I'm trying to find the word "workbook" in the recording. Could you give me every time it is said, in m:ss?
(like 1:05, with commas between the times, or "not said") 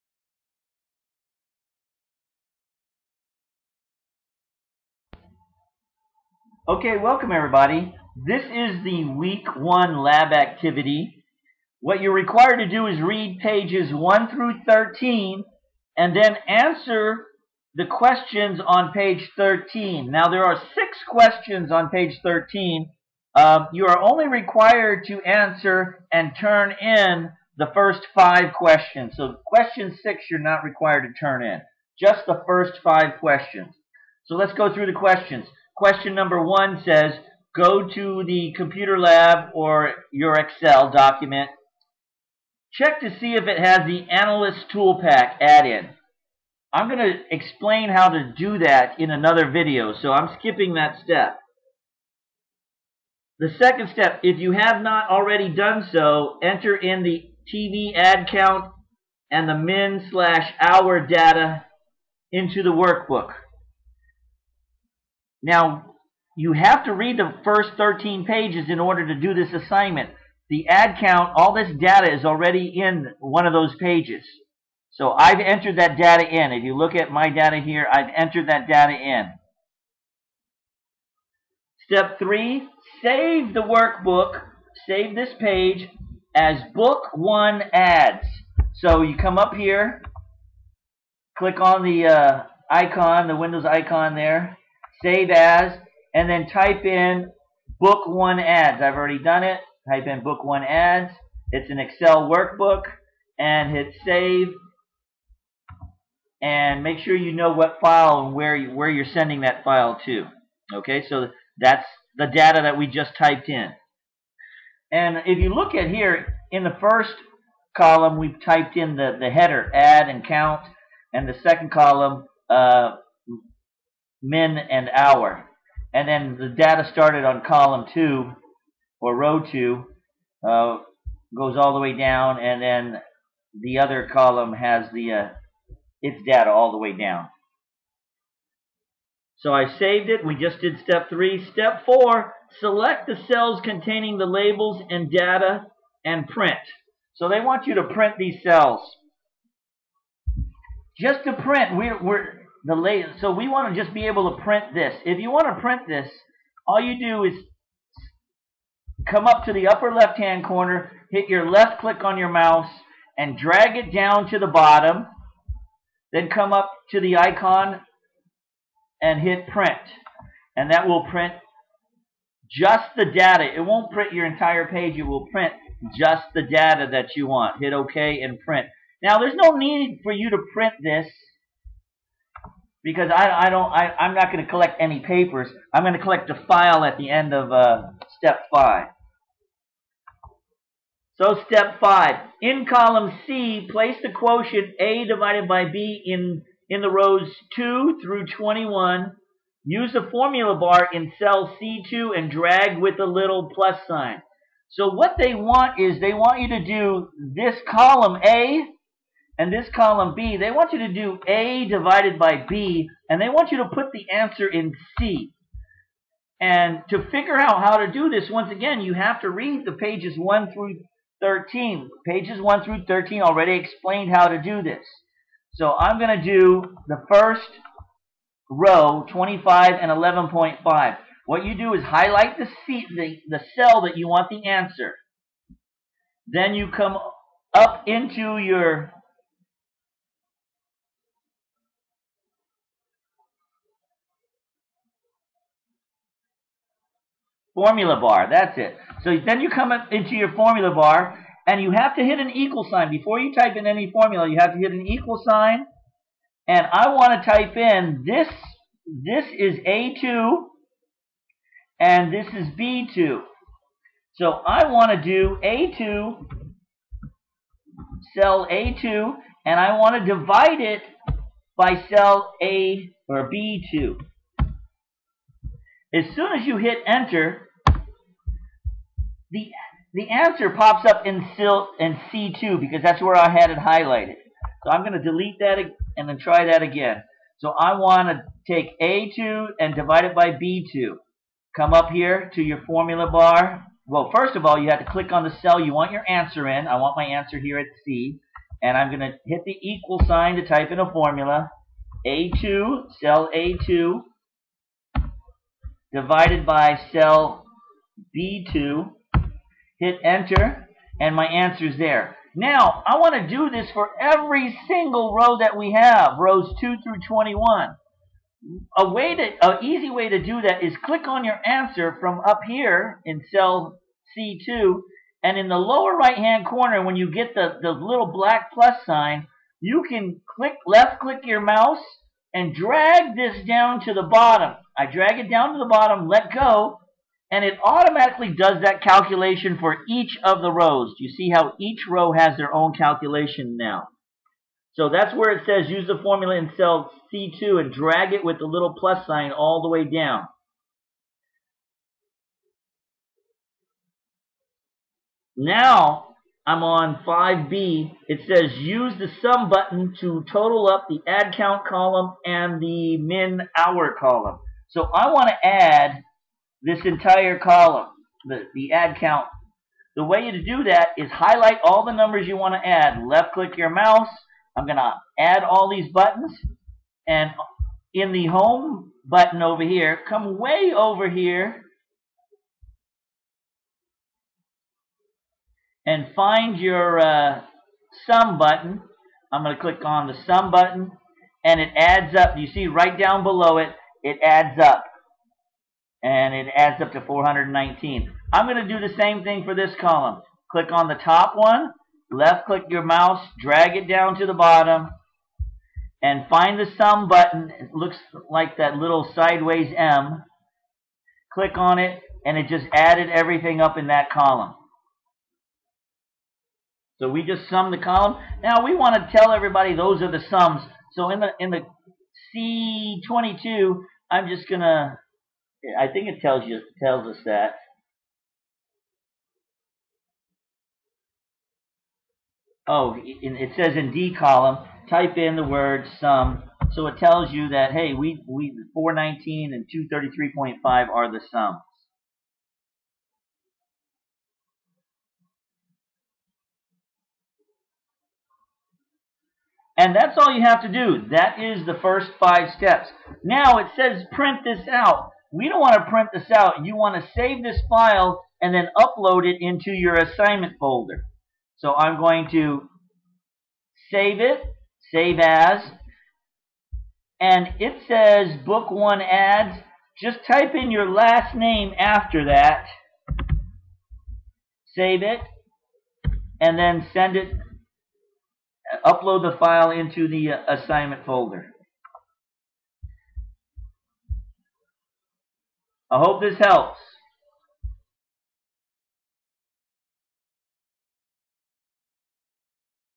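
1:02, 1:23, 1:42.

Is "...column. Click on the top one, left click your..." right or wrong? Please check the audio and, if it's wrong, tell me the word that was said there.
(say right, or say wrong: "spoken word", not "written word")
right.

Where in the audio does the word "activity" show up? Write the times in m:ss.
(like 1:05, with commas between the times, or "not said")
0:10.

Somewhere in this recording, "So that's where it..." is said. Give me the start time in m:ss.
5:44.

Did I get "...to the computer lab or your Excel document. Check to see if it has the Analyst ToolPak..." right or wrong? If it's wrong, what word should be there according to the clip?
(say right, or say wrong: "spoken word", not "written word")
right.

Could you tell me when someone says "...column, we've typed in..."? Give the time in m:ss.
1:57.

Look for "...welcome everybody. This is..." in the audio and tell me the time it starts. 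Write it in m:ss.
0:06.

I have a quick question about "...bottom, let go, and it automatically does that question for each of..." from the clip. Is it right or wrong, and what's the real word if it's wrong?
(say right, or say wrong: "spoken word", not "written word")
wrong: "calculation", not "question".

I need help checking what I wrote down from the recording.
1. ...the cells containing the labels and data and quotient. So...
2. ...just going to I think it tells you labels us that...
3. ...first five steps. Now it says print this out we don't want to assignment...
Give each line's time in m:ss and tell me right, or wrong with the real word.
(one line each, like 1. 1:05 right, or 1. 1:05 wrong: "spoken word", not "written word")
1. 2:23 wrong: "print", not "quotient"
2. 7:04 wrong: "tells", not "labels"
3. 7:31 wrong: "print", not "assignment".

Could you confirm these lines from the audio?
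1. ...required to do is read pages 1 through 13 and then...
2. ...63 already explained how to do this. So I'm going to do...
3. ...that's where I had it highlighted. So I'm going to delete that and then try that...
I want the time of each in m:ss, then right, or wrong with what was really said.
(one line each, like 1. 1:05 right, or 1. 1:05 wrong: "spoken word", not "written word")
1. 0:12 right
2. 3:42 wrong: "13", not "63"
3. 4:42 right.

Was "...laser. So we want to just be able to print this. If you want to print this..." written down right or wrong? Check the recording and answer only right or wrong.
right.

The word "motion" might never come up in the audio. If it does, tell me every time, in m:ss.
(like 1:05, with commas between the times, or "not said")
not said.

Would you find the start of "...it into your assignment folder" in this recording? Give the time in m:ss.
7:39.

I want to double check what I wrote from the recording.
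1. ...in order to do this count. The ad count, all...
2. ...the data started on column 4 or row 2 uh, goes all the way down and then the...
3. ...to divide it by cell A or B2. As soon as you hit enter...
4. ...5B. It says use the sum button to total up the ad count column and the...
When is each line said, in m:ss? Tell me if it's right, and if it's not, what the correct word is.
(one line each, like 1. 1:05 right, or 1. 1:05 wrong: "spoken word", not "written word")
1. 1:08 wrong: "assignment", not "count"
2. 2:06 wrong: "2", not "4"
3. 4:30 right
4. 5:57 right.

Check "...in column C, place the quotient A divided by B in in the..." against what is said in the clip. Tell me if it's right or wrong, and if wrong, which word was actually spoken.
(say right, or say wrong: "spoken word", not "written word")
right.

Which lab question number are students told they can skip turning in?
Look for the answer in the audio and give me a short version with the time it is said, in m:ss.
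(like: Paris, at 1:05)
6, at 0:29.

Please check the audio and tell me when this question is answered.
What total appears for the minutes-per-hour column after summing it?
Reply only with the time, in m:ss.
7:19.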